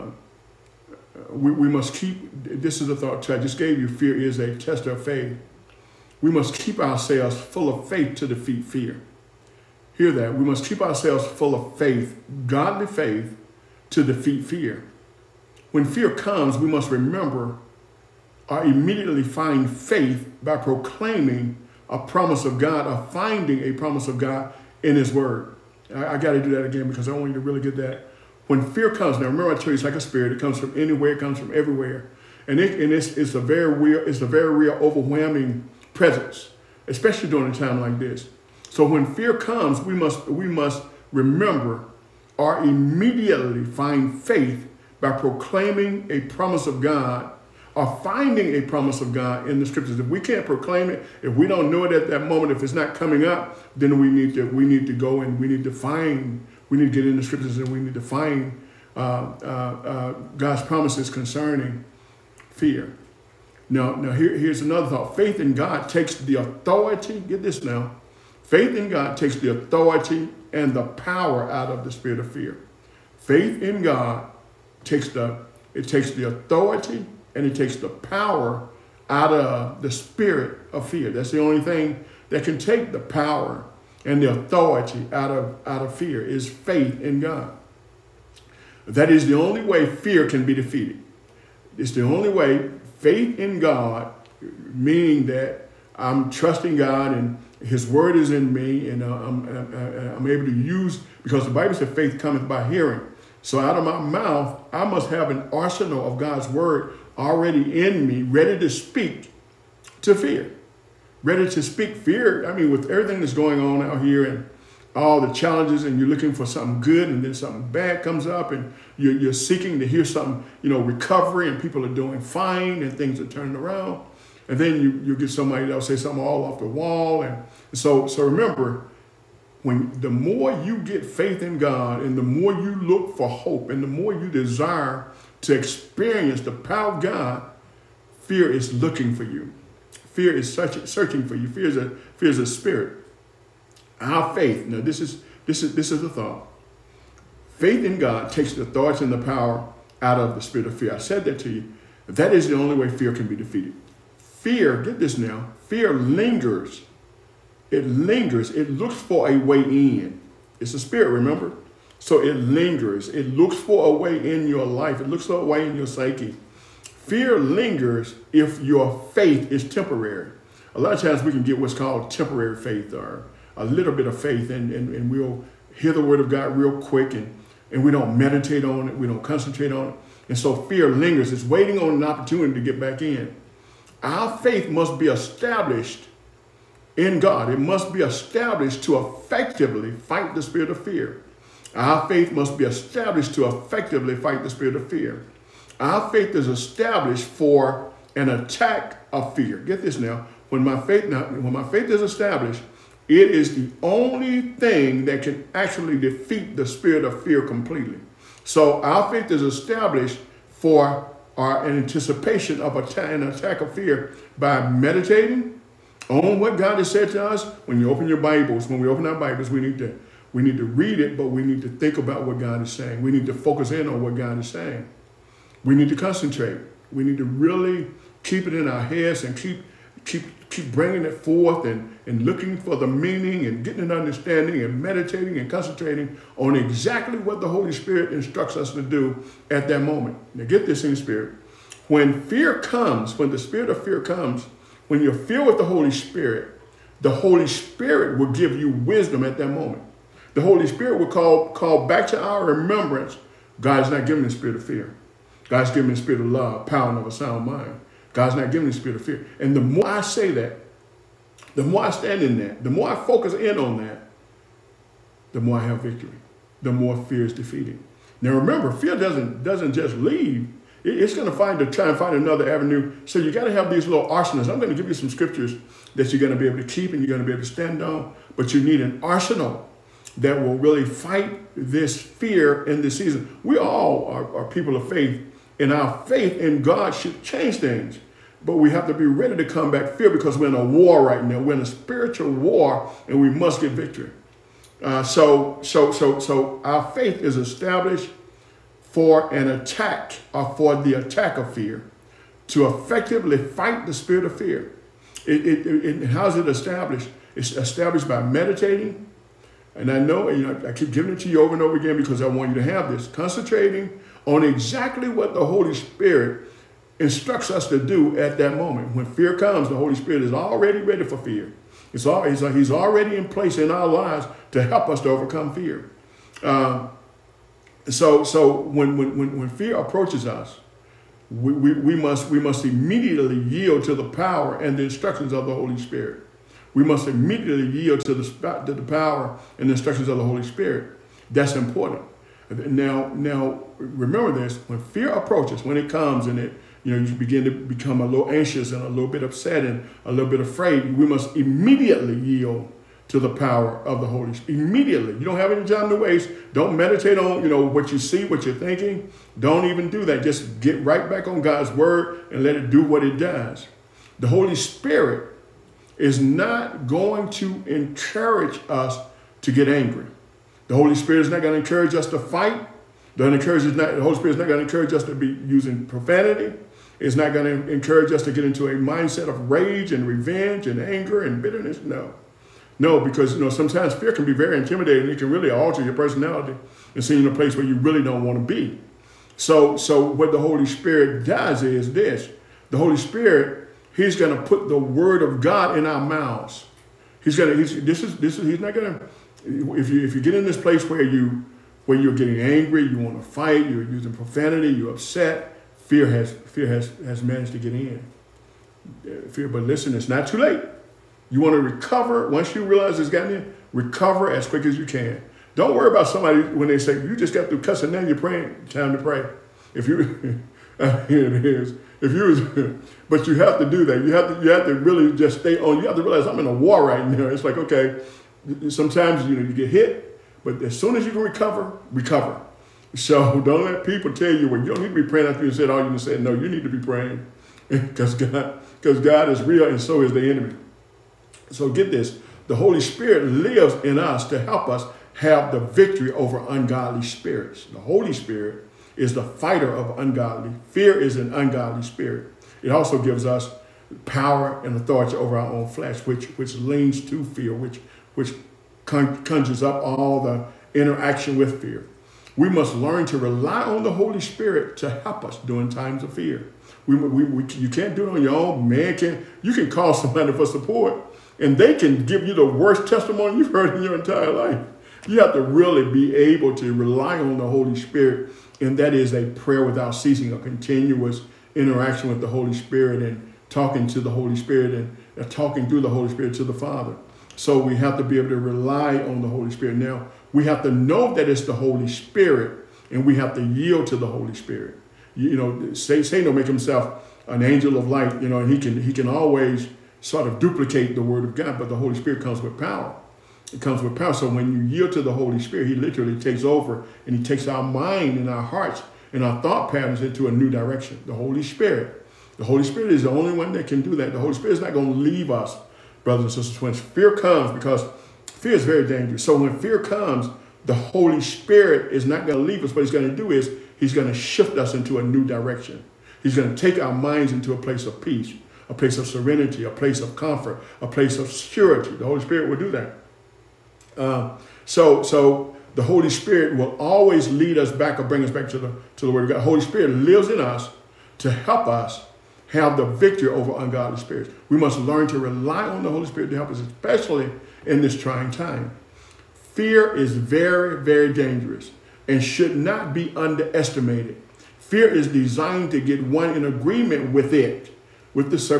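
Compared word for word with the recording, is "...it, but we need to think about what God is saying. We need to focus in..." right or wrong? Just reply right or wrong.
right.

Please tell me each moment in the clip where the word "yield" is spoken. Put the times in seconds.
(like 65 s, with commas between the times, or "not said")
333 s, 337 s, 352 s, 493 s, 504 s.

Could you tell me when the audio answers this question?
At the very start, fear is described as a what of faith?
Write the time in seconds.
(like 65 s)
4 s.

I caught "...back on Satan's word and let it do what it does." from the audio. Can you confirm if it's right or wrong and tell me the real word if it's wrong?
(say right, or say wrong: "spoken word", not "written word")
wrong: "God", not "Satan".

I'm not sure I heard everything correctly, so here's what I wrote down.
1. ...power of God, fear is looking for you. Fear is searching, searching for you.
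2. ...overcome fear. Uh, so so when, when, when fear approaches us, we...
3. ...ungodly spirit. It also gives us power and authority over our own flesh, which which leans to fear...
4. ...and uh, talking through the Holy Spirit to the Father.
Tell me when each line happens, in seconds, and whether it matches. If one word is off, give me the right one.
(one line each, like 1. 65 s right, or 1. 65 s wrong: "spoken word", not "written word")
1. 136 s right
2. 325 s right
3. 451 s right
4. 484 s right.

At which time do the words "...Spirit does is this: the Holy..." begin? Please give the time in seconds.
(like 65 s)
390 s.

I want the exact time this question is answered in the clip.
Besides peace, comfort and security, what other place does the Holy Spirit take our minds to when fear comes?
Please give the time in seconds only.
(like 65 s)
529 s.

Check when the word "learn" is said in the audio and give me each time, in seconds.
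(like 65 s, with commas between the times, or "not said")
462 s, 544 s.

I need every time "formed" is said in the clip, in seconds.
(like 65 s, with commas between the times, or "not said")
not said.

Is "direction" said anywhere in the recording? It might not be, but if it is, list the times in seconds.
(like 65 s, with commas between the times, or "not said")
510 s, 525 s.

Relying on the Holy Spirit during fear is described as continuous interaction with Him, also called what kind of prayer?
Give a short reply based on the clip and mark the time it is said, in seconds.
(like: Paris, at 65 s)
prayer without ceasing, at 479 s.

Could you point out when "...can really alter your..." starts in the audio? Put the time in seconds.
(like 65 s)
385 s.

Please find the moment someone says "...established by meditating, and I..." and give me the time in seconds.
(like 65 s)
307 s.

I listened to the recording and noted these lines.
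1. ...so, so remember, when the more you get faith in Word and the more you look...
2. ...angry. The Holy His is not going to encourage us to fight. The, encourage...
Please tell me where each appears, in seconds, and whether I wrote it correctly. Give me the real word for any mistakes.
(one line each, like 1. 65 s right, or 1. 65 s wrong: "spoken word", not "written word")
1. 127 s wrong: "God", not "Word"
2. 369 s wrong: "Spirit", not "His".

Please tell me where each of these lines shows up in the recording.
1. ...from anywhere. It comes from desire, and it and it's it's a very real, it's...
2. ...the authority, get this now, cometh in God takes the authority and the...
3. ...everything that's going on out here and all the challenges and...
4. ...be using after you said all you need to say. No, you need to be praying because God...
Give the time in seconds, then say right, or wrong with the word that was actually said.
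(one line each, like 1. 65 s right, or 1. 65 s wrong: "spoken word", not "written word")
1. 30 s wrong: "everywhere", not "desire"
2. 66 s wrong: "faith", not "cometh"
3. 112 s right
4. 435 s wrong: "praying", not "using".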